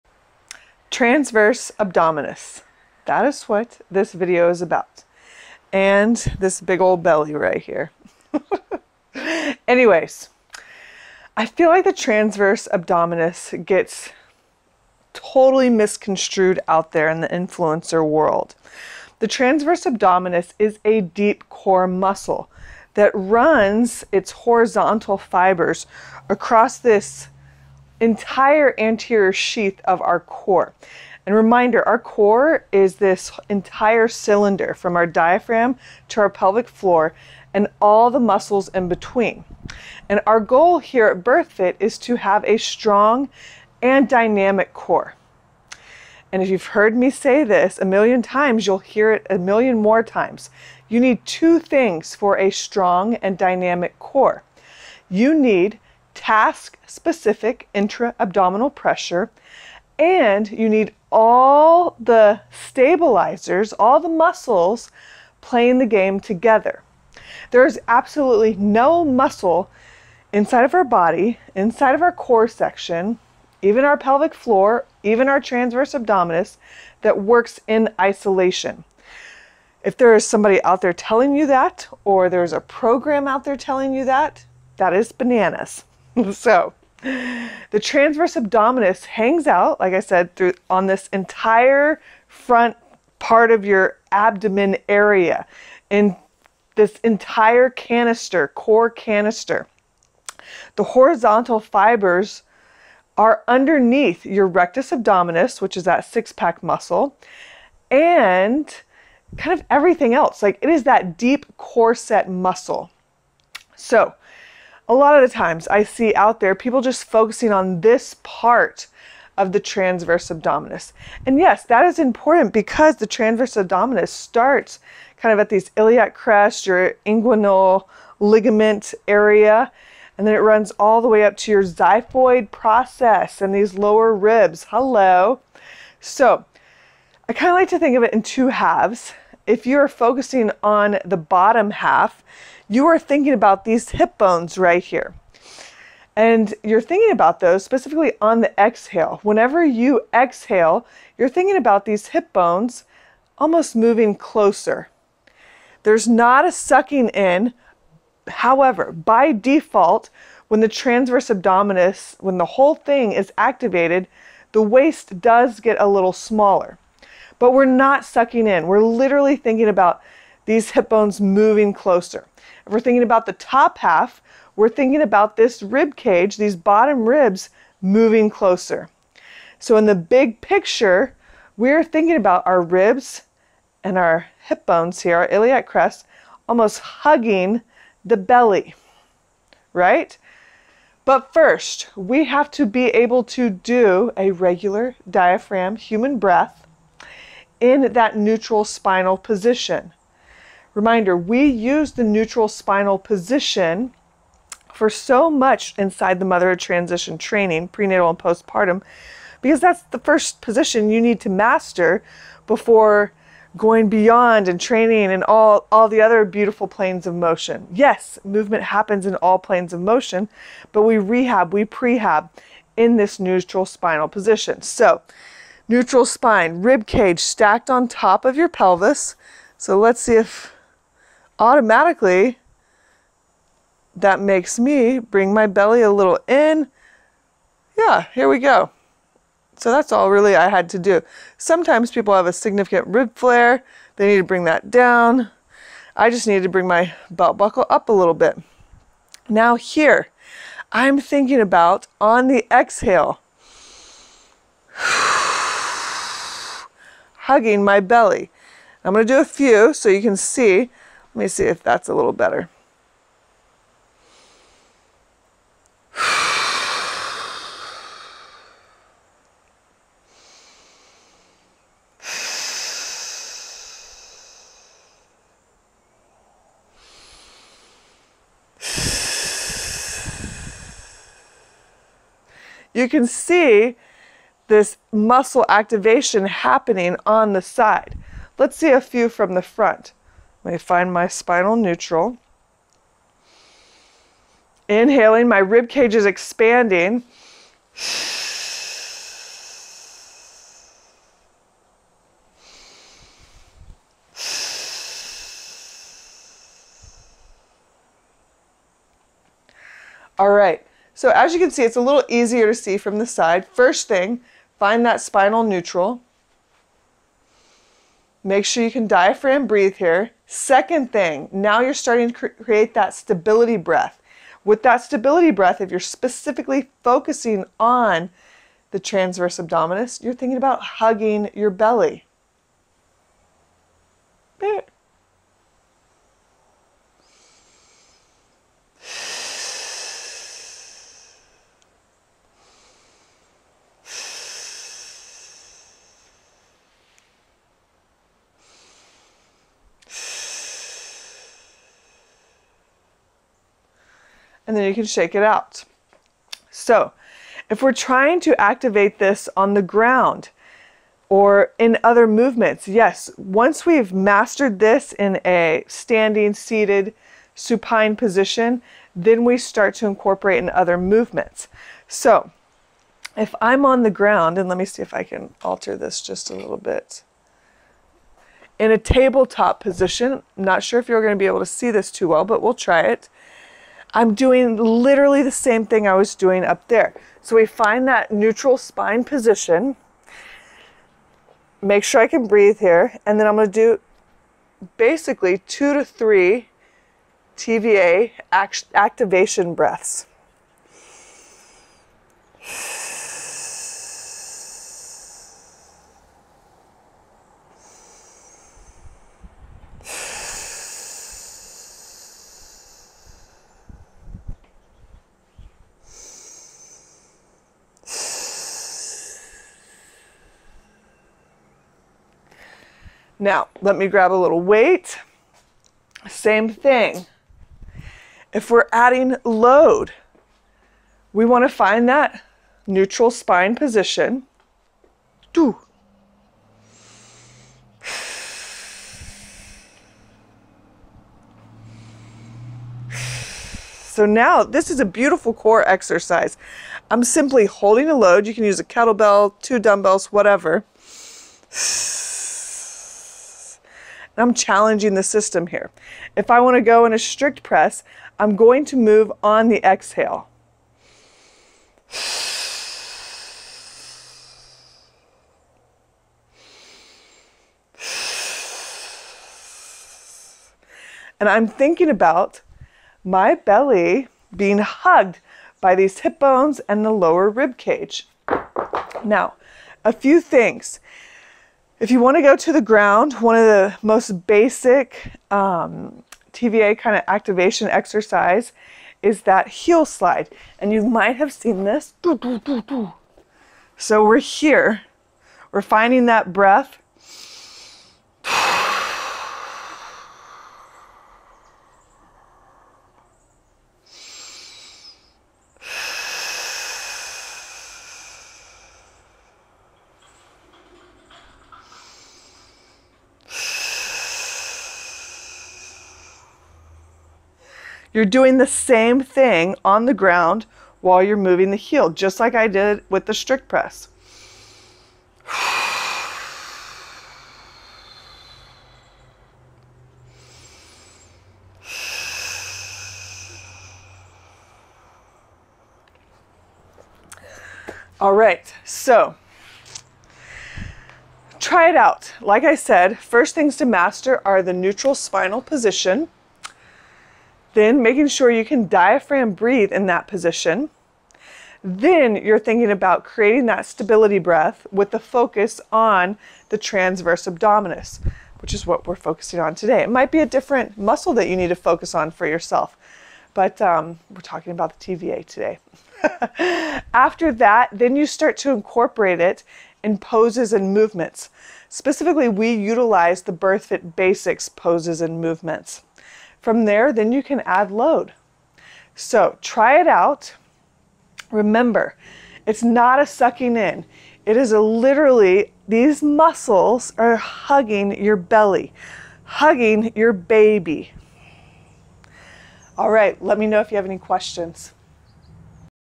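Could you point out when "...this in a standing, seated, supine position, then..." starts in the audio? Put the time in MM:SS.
06:04.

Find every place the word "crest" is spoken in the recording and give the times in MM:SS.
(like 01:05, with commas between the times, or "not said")
02:06, 03:05.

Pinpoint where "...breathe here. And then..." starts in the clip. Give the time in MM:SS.
06:32.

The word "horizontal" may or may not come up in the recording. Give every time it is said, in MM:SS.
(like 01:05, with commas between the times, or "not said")
00:24, 01:40.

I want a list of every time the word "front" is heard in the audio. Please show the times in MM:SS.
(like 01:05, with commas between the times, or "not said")
01:32, 04:49.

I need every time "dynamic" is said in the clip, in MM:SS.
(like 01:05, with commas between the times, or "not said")
00:44, 00:53.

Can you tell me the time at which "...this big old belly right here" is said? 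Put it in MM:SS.
00:06.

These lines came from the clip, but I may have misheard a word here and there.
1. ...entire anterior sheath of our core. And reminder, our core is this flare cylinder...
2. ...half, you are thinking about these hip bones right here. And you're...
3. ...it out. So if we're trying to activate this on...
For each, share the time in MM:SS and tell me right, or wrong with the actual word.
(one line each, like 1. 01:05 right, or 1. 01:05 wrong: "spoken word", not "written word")
1. 00:28 wrong: "entire", not "flare"
2. 02:21 right
3. 05:55 right.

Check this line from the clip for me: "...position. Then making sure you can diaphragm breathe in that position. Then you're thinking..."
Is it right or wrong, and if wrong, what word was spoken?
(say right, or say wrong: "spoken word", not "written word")
right.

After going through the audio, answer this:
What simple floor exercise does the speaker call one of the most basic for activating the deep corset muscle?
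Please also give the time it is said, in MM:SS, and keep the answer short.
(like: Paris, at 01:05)
heel slide, at 08:09.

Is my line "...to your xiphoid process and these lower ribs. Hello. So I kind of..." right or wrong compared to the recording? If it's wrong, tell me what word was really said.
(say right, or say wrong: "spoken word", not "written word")
right.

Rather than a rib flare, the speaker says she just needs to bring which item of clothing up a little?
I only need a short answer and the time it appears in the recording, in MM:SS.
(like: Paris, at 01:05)
belt buckle, at 04:07.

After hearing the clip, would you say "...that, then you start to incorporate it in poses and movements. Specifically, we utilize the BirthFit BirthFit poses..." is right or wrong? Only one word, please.
wrong.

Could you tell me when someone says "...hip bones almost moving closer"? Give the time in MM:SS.
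02:32.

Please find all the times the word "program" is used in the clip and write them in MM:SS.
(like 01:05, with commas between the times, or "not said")
01:22.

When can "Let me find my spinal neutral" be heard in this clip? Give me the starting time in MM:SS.
04:50.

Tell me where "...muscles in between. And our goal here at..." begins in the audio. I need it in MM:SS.
00:38.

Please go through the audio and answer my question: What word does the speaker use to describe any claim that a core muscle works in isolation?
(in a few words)
bananas.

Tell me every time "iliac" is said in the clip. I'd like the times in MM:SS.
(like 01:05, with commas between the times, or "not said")
02:05, 03:05.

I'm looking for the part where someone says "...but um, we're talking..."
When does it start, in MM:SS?
09:23.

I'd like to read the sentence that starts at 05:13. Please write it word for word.
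First thing, find that spinal neutral.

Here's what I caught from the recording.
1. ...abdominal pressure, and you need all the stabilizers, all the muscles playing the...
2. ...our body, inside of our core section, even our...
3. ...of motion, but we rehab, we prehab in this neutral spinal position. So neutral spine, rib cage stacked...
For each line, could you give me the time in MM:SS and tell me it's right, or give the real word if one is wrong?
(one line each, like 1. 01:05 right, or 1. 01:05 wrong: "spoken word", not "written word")
1. 00:58 right
2. 01:10 right
3. 03:39 right.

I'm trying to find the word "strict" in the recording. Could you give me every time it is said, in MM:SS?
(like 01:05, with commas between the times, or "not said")
07:36, 08:43.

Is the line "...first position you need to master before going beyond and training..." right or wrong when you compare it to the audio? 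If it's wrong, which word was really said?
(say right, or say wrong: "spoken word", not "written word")
right.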